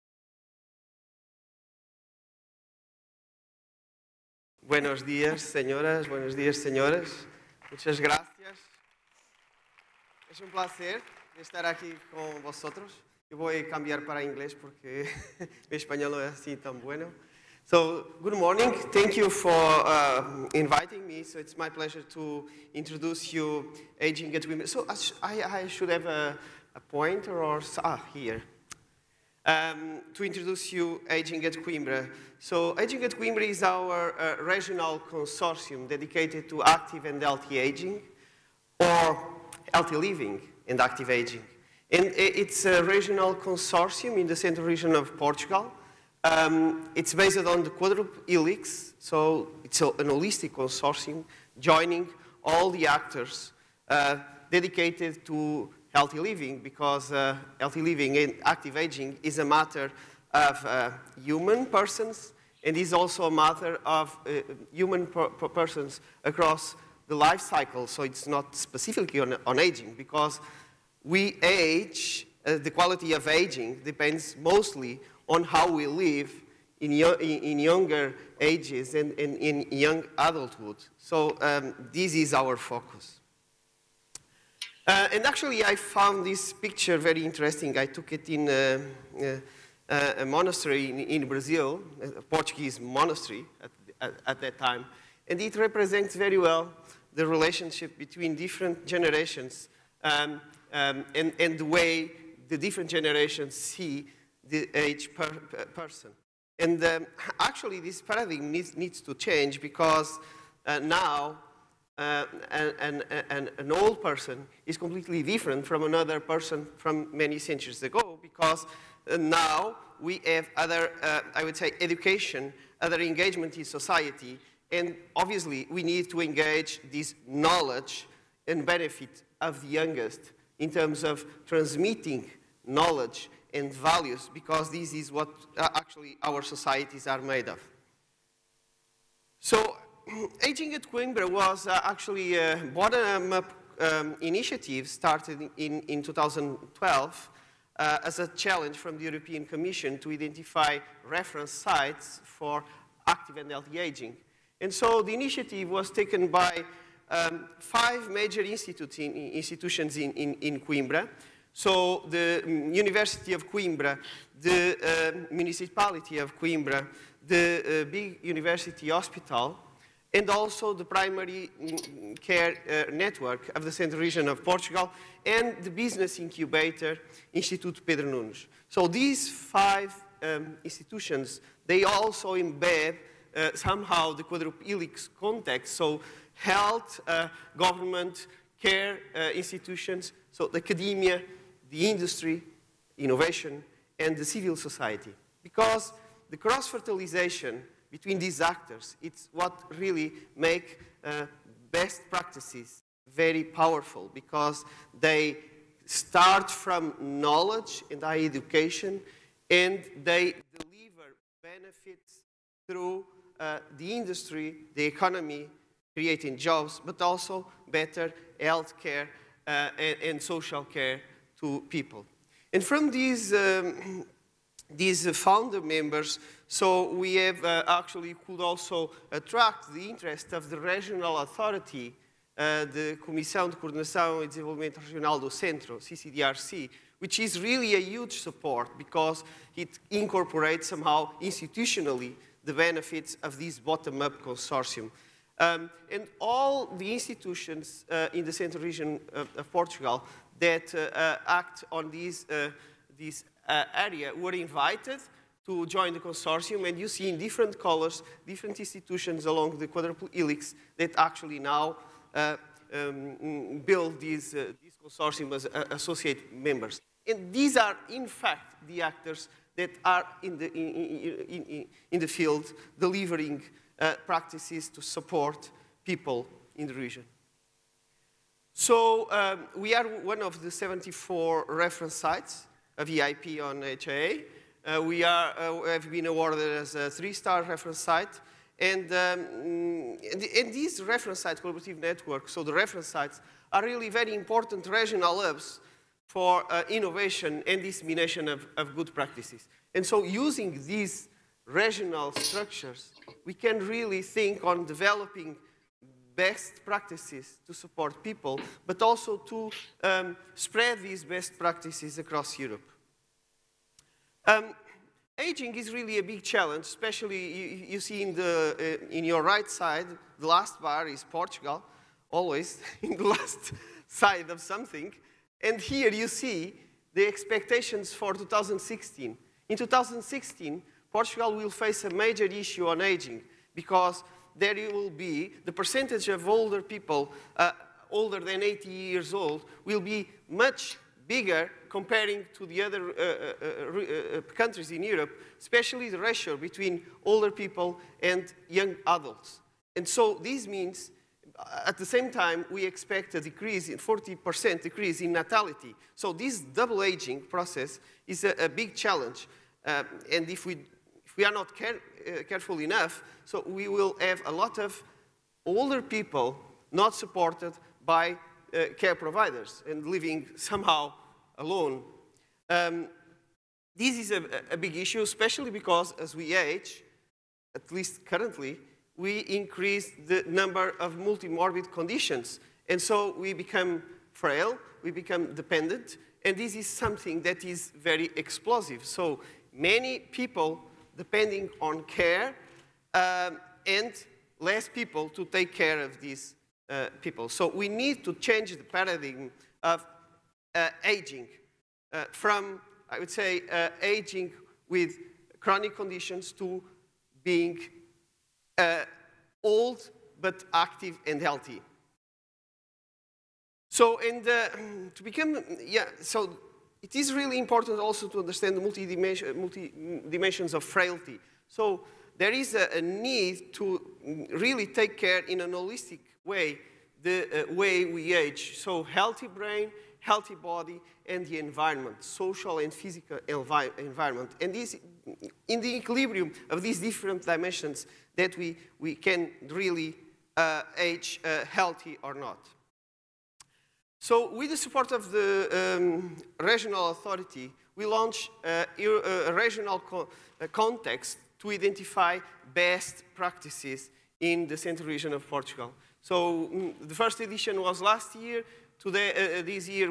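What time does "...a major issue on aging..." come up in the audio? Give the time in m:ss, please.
5:31.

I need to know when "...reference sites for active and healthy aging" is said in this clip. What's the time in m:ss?
2:31.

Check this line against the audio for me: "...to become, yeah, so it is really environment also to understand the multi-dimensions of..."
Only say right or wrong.
wrong.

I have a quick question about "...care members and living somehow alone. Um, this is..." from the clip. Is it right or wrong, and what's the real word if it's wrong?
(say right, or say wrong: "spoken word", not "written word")
wrong: "providers", not "members".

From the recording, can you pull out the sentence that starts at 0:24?
So, I, I should have a, a pointer or ah, here.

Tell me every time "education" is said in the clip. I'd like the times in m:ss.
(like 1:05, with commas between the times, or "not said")
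2:01, 3:28.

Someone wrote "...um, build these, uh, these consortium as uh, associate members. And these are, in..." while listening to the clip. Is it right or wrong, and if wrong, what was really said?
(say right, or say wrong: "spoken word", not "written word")
right.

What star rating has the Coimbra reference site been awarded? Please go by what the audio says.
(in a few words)
three-star.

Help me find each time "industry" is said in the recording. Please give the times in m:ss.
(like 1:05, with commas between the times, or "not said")
3:11, 3:33.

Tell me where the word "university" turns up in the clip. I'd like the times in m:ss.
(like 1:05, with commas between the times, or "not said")
2:42, 2:48.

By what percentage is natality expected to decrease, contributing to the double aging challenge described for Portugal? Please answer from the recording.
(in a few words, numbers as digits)
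40%.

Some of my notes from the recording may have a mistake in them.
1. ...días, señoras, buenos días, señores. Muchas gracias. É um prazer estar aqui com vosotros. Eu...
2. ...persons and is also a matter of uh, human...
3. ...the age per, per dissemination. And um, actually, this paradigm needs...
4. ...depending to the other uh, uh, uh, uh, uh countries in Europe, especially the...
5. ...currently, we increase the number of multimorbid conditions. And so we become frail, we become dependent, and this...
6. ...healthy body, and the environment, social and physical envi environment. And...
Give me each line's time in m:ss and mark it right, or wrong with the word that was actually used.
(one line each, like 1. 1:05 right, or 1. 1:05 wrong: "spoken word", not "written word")
1. 0:05 right
2. 1:01 right
3. 1:44 wrong: "person", not "dissemination"
4. 5:41 wrong: "comparing", not "depending"
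5. 6:18 right
6. 7:09 right.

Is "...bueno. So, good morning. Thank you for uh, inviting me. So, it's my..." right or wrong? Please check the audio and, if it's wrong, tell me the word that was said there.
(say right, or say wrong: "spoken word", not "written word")
right.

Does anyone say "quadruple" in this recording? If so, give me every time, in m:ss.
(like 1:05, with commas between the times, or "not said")
0:47, 3:04, 4:19.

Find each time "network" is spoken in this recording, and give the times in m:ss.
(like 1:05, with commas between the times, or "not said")
2:52, 4:51.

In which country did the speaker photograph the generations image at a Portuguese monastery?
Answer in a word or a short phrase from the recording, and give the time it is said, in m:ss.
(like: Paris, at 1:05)
Brazil, at 1:31.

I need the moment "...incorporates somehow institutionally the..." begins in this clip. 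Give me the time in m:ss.
3:59.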